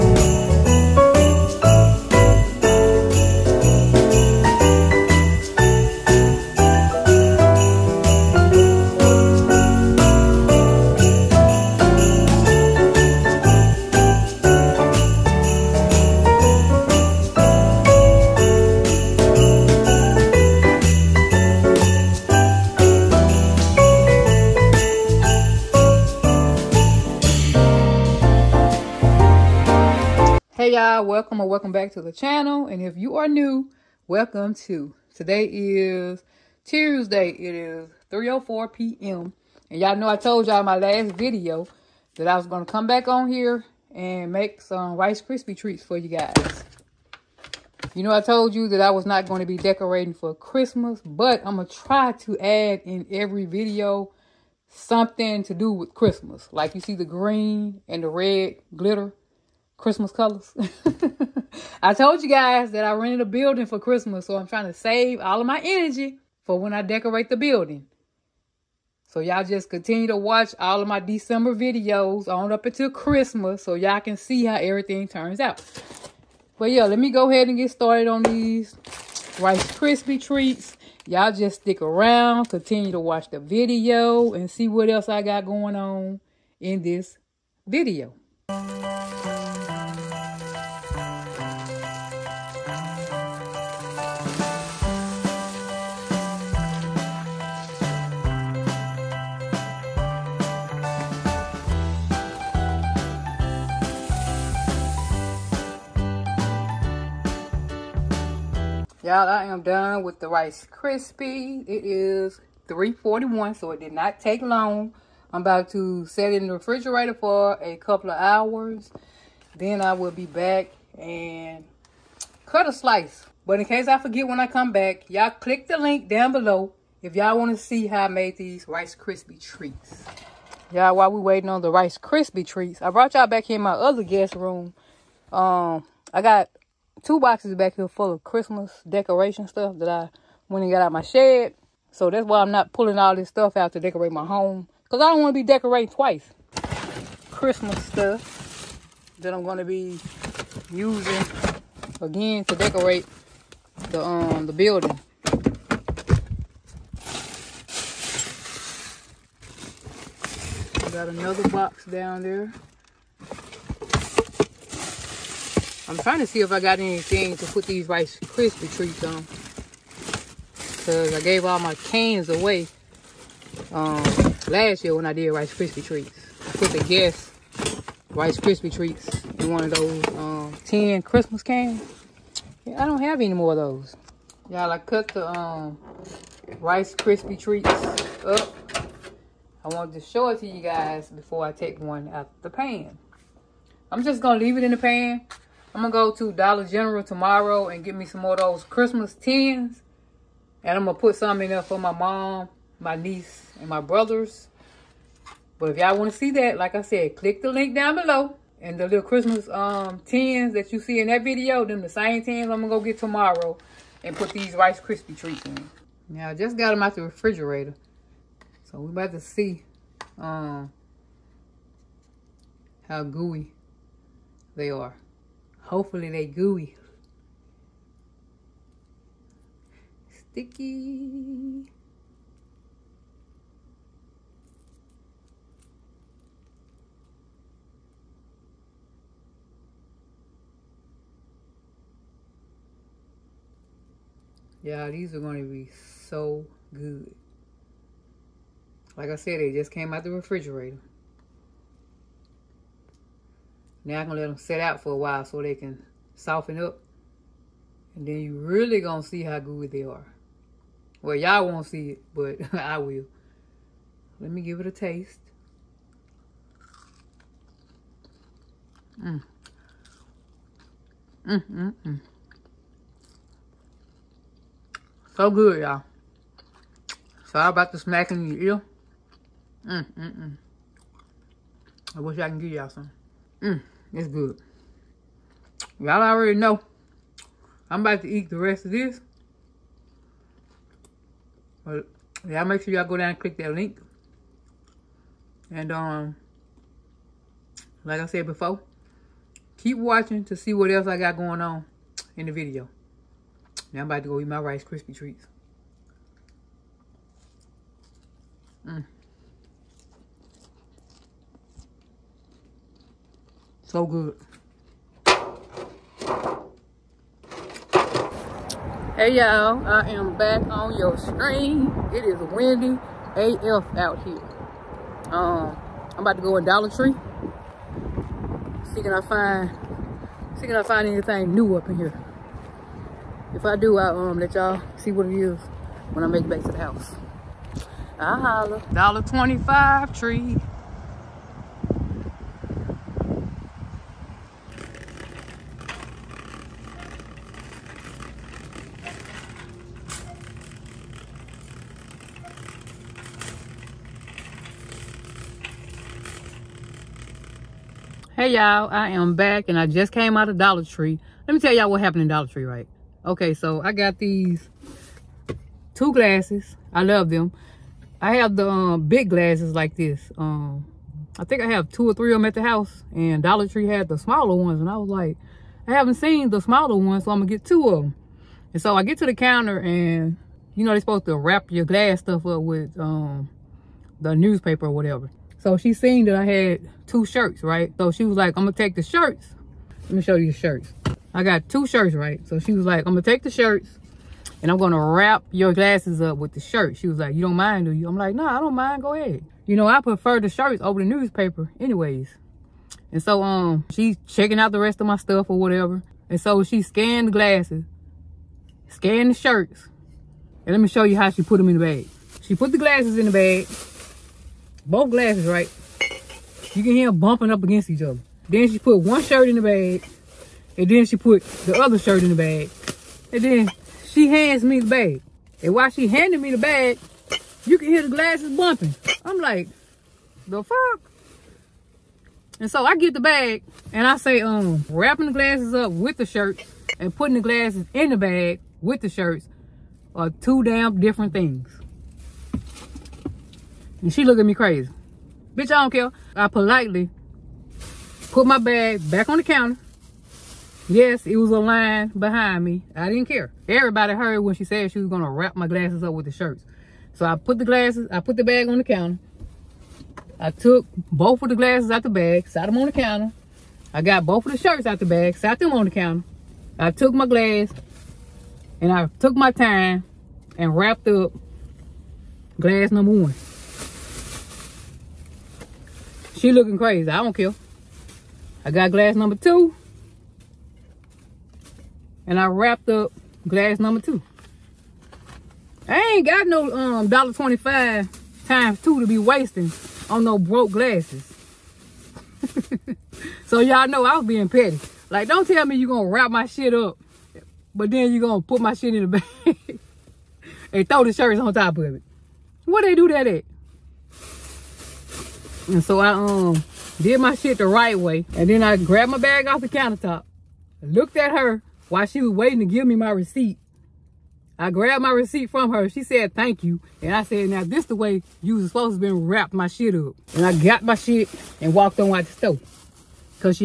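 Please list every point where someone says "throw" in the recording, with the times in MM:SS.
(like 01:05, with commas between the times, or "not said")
08:20.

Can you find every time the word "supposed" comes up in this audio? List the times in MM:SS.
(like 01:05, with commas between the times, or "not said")
06:20, 08:38.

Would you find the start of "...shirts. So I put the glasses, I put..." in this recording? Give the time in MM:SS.
07:36.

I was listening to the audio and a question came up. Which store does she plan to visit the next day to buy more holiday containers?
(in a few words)
Dollar General.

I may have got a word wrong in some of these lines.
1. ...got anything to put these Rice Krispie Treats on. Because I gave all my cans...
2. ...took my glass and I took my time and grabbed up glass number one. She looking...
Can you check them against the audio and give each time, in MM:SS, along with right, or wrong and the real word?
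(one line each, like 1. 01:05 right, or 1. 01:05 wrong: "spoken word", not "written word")
1. 02:46 right
2. 07:46 wrong: "wrapped", not "grabbed".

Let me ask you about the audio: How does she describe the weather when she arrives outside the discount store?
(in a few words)
windy.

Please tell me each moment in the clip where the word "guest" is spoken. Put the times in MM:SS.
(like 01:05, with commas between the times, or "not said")
02:14, 02:56.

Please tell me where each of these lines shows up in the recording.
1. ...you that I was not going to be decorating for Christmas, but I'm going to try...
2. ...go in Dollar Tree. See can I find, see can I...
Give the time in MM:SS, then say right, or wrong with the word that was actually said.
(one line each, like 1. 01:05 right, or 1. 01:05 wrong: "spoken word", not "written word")
1. 00:48 right
2. 05:26 right.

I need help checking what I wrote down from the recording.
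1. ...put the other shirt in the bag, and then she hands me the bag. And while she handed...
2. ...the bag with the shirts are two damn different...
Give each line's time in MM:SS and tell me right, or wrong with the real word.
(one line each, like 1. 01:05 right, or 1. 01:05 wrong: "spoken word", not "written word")
1. 07:00 right
2. 07:17 right.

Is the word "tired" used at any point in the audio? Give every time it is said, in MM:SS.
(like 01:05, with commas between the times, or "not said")
not said.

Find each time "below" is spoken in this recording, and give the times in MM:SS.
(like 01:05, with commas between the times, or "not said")
02:06, 03:27.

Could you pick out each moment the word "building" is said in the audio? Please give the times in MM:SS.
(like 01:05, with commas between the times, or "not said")
01:03, 01:07, 02:34.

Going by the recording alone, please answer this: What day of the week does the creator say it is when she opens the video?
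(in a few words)
Tuesday.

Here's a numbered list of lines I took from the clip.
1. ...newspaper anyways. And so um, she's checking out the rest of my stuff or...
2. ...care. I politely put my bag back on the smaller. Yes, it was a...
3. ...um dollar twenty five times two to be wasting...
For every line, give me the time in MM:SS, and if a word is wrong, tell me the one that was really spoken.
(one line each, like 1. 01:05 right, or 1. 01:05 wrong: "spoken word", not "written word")
1. 06:40 right
2. 07:25 wrong: "counter", not "smaller"
3. 08:06 right.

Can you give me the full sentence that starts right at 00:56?
Like you see the green and the red glitter.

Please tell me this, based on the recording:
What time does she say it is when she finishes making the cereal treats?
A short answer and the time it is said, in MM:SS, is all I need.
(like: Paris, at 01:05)
3:41, at 01:52.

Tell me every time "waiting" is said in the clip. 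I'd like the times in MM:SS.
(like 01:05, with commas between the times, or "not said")
02:11, 08:32.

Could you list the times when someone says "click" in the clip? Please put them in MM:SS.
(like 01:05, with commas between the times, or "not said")
02:05, 03:27, 04:53.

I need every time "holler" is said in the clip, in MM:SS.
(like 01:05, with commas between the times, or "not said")
05:38.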